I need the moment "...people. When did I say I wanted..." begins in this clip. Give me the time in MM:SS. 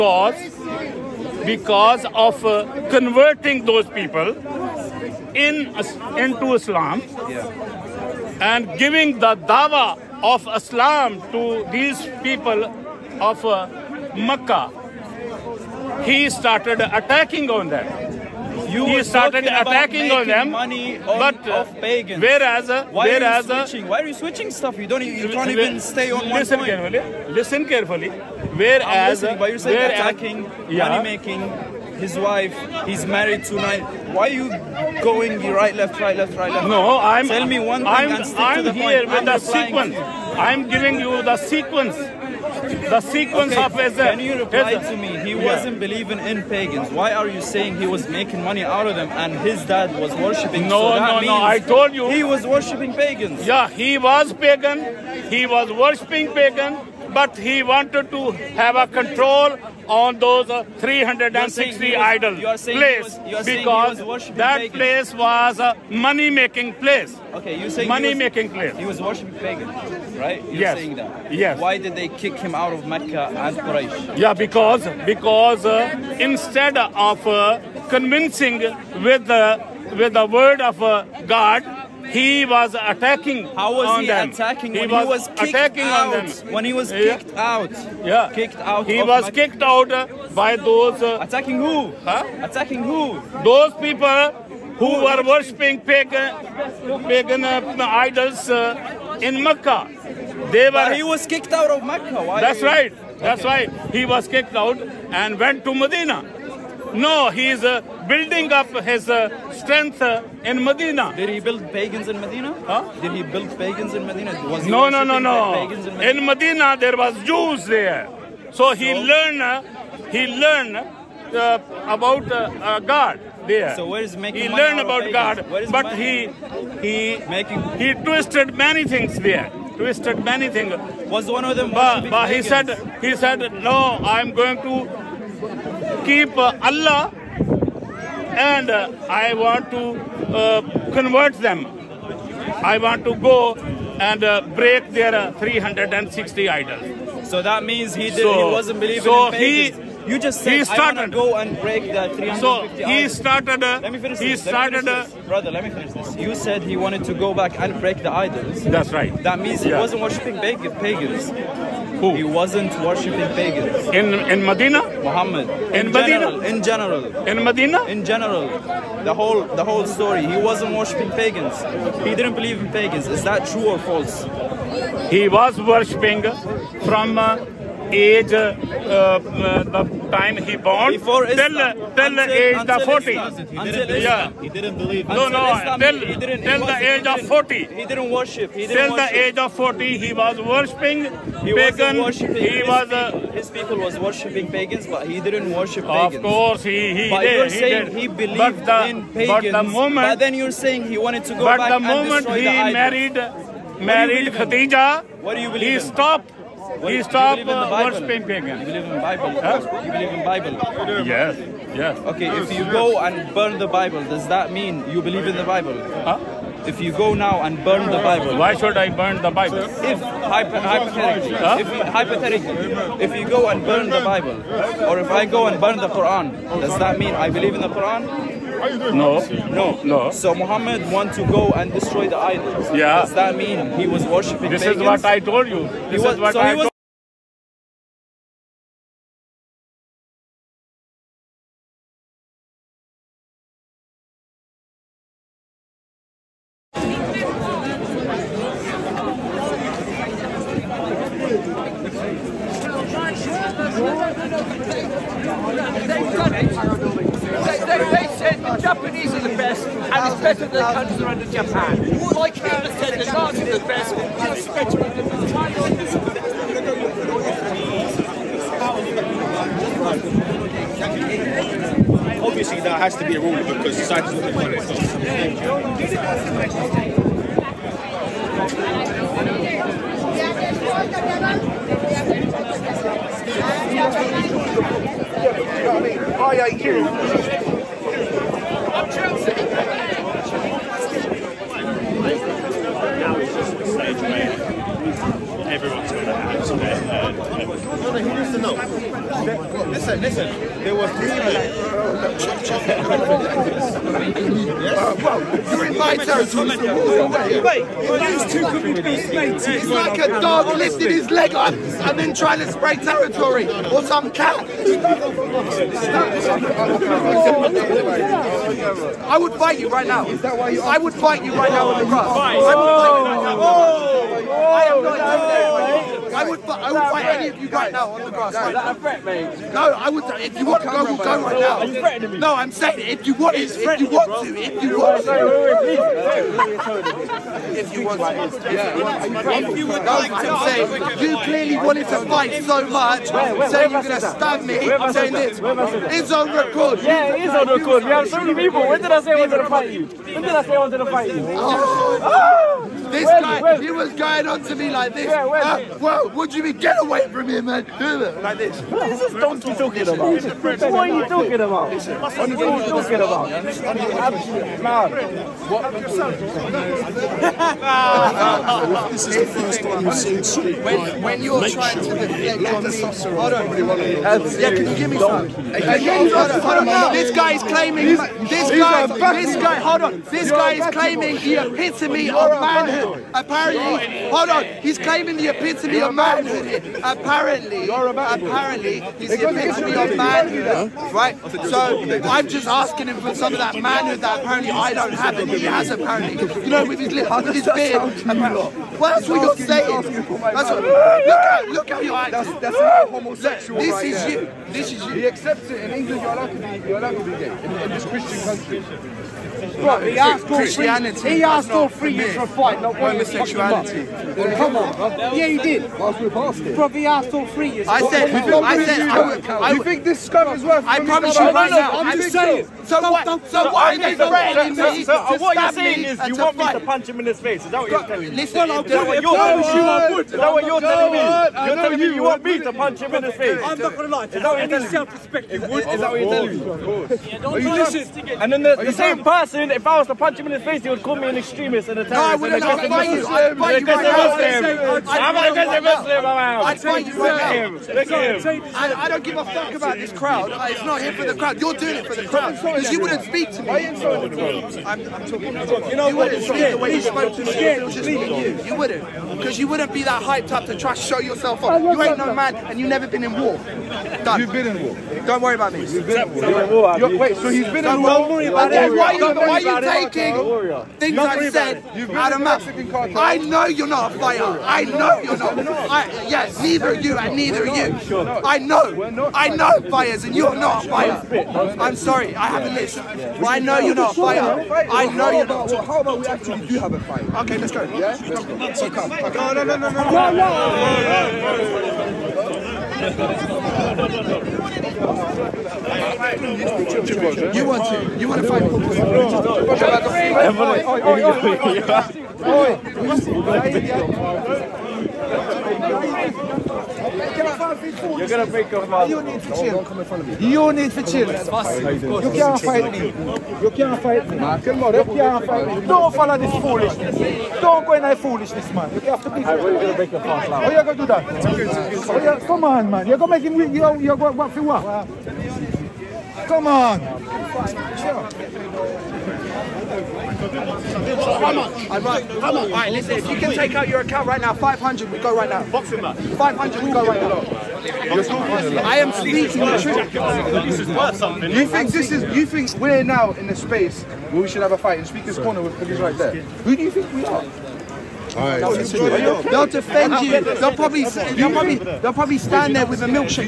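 05:48.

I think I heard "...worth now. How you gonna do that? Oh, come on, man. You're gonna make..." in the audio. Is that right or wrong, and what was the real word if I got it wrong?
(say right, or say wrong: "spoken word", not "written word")
wrong: "mouth", not "worth".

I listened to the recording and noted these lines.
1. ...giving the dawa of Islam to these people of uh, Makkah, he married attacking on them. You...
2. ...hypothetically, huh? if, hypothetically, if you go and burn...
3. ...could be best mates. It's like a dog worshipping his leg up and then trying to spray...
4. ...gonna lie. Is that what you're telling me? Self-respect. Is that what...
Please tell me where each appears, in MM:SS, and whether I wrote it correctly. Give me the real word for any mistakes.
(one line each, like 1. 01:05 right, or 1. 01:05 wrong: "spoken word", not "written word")
1. 00:08 wrong: "started", not "married"
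2. 03:40 right
3. 05:08 wrong: "lifting", not "worshipping"
4. 07:13 right.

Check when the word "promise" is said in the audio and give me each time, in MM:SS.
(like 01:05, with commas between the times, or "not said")
07:00, 07:08.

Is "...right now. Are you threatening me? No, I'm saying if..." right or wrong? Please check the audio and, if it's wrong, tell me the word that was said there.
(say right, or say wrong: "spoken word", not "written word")
right.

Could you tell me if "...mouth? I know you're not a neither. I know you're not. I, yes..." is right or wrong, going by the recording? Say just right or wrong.
wrong.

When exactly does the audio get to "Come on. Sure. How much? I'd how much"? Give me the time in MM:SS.
08:46.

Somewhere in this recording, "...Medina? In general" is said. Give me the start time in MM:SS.
02:47.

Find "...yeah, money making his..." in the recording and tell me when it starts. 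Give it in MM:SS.
00:30.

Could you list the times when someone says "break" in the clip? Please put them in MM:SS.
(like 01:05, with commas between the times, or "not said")
02:24, 02:31, 02:37, 08:39.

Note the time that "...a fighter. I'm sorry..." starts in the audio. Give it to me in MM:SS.
08:00.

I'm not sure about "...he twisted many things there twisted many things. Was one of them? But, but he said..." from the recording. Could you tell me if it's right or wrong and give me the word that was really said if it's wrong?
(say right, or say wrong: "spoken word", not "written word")
right.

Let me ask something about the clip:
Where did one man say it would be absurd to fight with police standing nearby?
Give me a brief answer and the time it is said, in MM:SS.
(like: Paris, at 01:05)
Speakers Corner, at 09:04.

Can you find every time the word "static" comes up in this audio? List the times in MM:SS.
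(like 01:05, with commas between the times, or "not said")
not said.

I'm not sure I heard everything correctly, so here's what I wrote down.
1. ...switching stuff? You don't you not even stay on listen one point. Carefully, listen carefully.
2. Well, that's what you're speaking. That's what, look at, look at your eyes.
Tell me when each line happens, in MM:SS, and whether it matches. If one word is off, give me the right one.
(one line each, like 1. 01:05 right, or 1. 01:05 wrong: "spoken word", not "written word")
1. 00:24 right
2. 06:38 wrong: "saying", not "speaking".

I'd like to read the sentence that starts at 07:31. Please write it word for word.
You're doing it for the crowd.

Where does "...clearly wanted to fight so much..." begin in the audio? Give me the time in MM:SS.
05:41.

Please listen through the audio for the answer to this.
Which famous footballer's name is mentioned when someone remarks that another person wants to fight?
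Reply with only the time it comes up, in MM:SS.
08:18.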